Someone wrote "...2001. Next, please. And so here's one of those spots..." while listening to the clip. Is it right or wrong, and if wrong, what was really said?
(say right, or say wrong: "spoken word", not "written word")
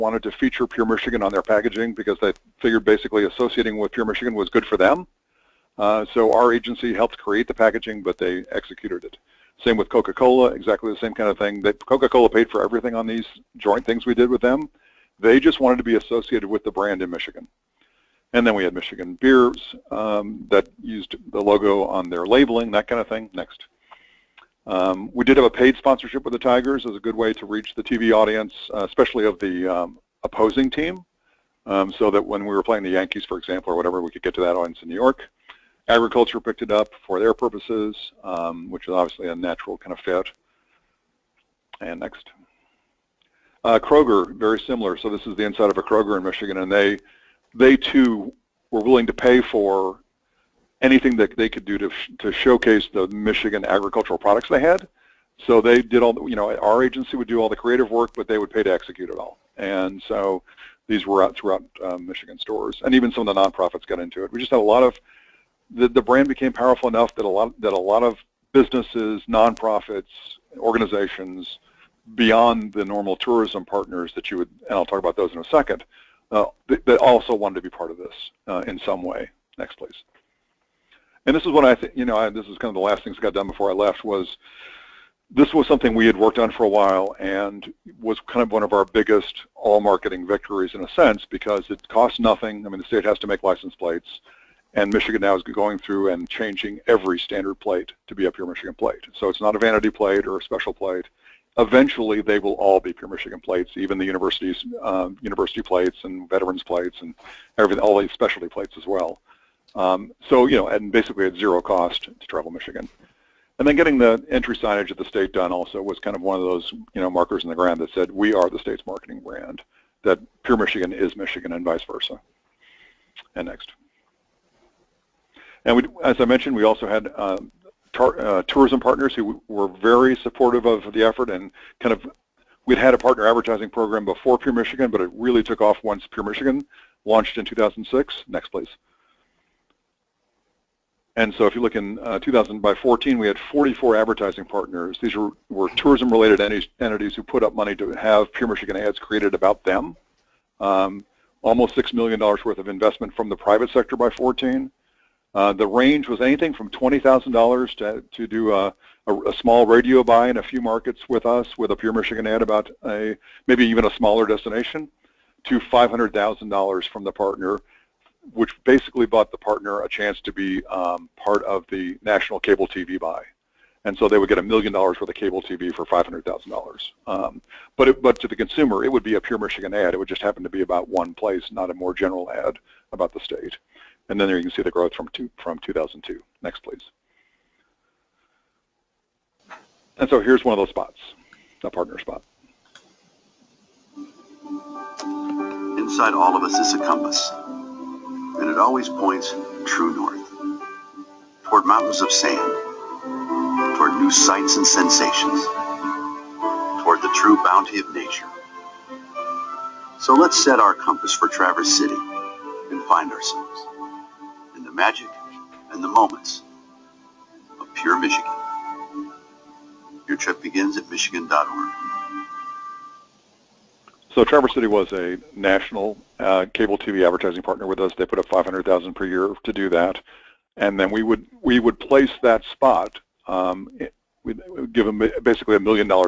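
wrong: "2002", not "2001".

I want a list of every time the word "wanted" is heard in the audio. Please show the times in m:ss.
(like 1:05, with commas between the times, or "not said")
0:15, 1:17.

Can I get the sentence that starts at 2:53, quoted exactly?
And so they would get a million dollars worth of cable TV for $500,000.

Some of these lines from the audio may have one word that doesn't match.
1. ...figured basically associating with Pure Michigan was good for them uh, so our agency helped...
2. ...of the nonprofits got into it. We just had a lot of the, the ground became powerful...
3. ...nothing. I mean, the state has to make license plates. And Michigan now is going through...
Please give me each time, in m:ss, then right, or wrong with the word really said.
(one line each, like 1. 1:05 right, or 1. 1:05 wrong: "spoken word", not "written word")
1. 0:02 right
2. 1:03 wrong: "brand", not "ground"
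3. 1:32 right.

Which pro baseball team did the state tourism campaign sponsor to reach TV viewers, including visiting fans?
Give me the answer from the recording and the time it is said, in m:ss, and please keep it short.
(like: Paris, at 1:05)
Tigers, at 0:26.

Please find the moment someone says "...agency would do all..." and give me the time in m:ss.
0:56.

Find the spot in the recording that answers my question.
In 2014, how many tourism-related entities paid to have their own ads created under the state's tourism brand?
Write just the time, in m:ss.
2:23.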